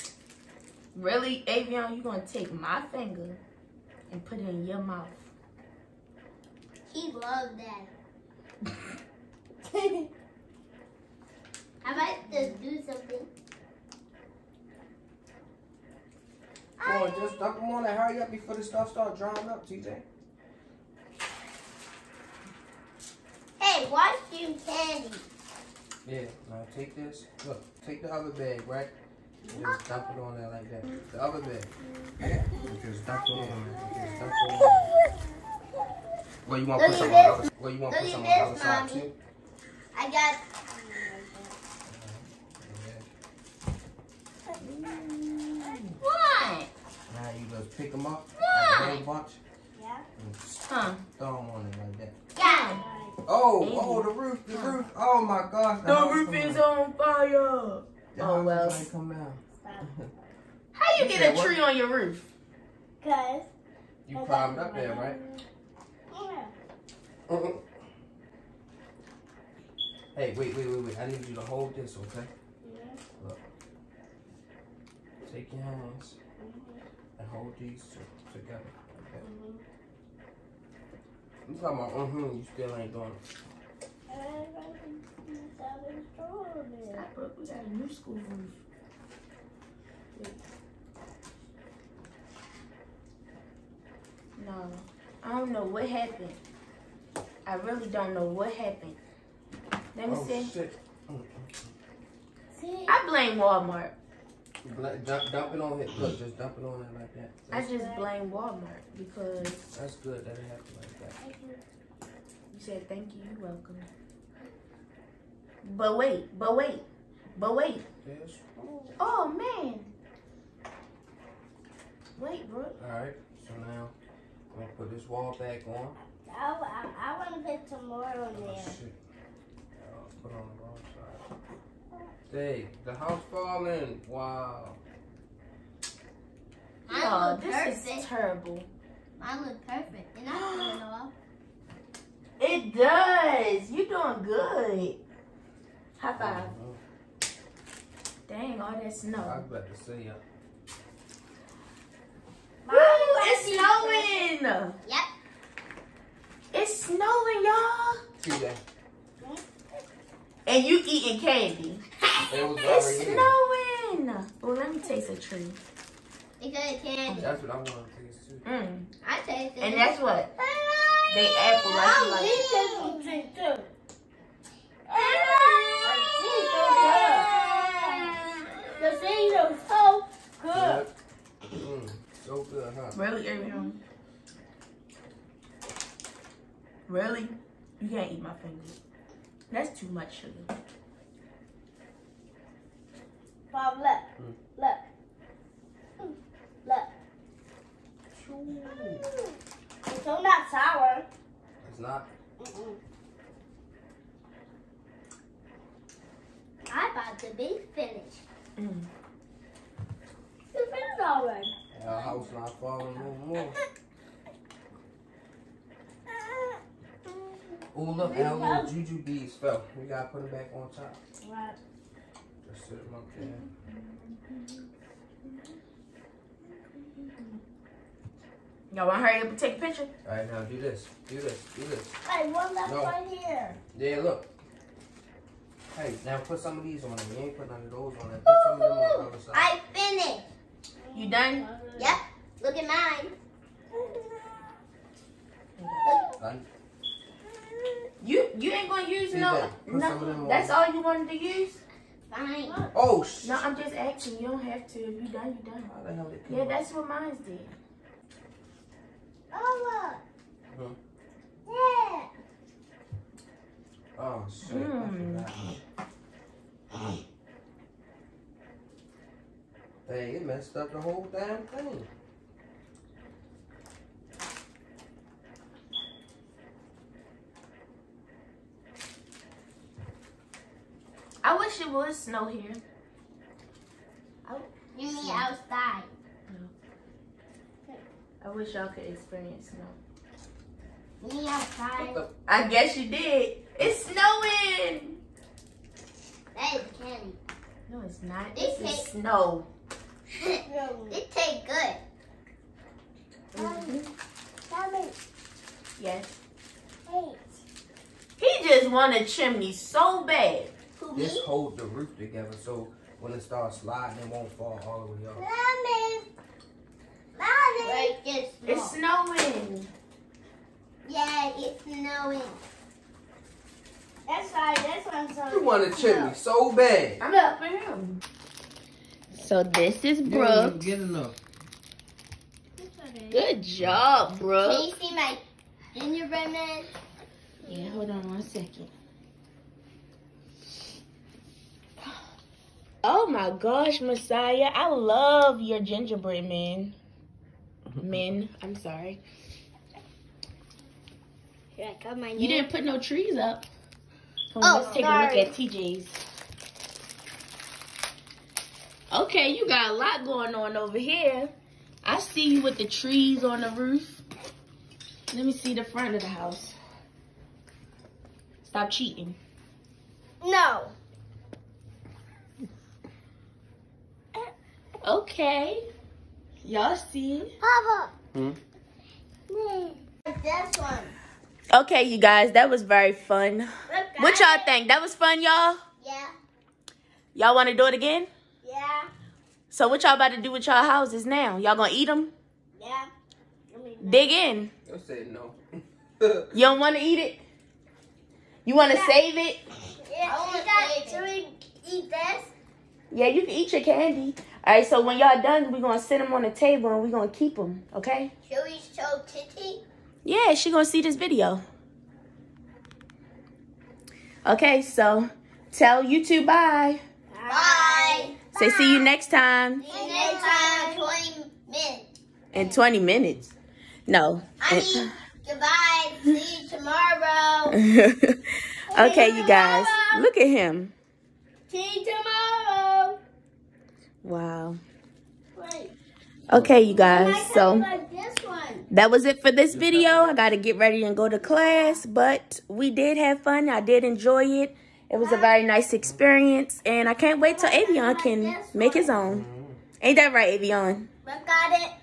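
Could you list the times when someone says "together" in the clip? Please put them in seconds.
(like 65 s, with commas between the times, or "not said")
78 s, 311 s.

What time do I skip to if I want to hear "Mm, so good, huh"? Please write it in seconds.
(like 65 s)
181 s.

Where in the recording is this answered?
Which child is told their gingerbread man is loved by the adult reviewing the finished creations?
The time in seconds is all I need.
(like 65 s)
342 s.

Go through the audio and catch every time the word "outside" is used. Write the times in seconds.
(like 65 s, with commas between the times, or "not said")
285 s, 291 s.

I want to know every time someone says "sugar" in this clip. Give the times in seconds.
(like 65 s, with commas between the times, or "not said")
190 s.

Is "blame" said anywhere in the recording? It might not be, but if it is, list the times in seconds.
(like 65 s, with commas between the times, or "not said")
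103 s, 107 s.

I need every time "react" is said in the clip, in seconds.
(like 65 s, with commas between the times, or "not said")
not said.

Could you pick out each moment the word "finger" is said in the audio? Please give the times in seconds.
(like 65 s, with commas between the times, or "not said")
2 s, 188 s.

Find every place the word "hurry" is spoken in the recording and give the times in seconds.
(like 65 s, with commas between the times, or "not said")
17 s, 229 s.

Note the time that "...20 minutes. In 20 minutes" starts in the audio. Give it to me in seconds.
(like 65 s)
420 s.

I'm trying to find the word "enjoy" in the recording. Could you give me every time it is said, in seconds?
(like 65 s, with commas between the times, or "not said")
443 s.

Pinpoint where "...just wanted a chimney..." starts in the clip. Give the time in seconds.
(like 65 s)
308 s.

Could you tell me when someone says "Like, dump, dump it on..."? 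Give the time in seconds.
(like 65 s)
104 s.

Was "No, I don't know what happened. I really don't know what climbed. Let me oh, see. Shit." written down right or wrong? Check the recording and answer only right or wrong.
wrong.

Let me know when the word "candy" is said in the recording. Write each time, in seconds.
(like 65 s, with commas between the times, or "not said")
24 s, 161 s, 166 s, 296 s, 403 s.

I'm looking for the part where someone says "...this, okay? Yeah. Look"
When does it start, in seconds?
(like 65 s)
71 s.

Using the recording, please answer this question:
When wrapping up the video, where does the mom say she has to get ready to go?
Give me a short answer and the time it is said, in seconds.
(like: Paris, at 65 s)
class, at 440 s.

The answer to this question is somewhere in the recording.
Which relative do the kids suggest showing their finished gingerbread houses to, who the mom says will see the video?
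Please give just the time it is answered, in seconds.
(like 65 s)
408 s.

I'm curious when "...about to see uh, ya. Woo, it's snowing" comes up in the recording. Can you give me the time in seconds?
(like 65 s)
149 s.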